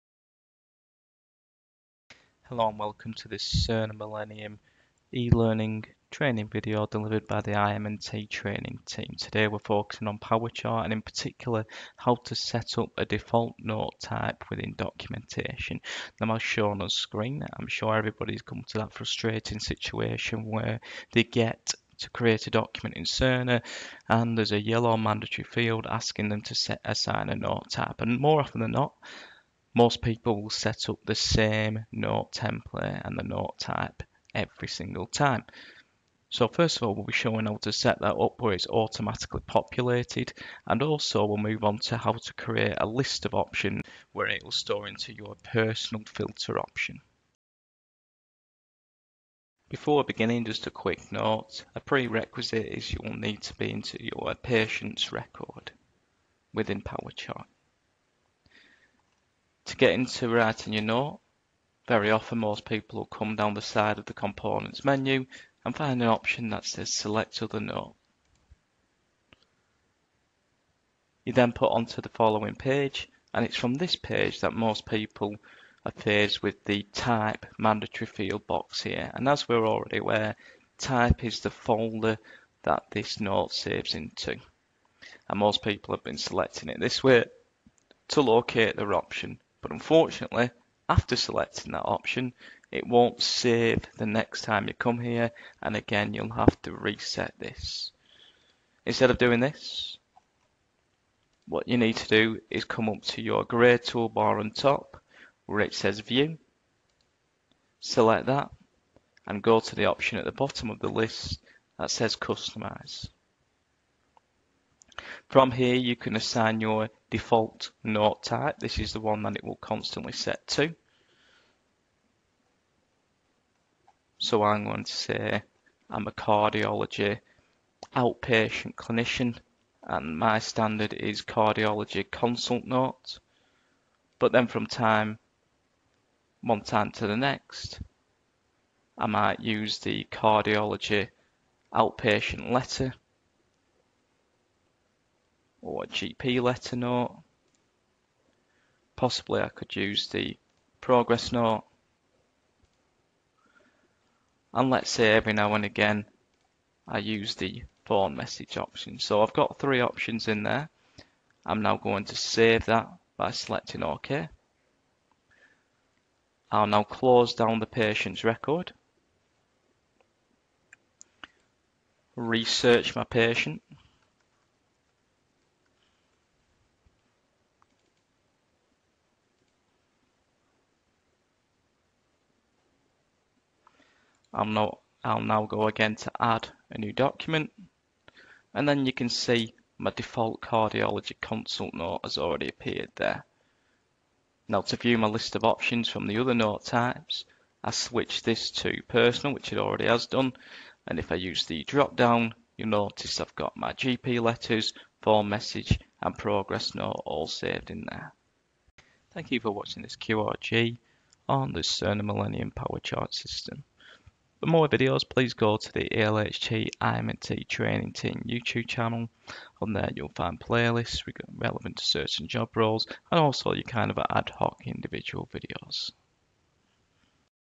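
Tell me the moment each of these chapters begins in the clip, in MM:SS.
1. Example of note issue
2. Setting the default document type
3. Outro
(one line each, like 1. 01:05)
1. 00:50
2. 01:38
3. 03:29.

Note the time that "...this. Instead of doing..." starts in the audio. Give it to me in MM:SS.
01:37.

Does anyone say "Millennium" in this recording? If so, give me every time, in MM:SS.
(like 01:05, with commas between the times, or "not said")
00:03, 03:32.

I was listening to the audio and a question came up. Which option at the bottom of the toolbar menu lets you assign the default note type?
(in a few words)
Customize.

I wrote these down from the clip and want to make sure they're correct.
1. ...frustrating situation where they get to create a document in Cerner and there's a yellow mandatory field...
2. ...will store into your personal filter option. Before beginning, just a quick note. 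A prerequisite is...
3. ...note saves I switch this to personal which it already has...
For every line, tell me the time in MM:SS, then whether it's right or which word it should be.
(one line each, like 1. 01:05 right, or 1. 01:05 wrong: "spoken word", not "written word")
1. 00:18 right
2. 00:44 right
3. 03:16 wrong: "types", not "saves".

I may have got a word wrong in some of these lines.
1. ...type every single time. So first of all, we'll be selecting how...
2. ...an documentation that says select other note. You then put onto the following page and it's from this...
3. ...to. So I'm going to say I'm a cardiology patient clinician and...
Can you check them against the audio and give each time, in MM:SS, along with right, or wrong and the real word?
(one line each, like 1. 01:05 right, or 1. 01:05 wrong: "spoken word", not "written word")
1. 00:33 wrong: "showing", not "selecting"
2. 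01:06 wrong: "option", not "documentation"
3. 02:00 wrong: "outpatient", not "patient".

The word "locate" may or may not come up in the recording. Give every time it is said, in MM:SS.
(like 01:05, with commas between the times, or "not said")
01:28.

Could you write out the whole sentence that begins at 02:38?
So I've got three options in there.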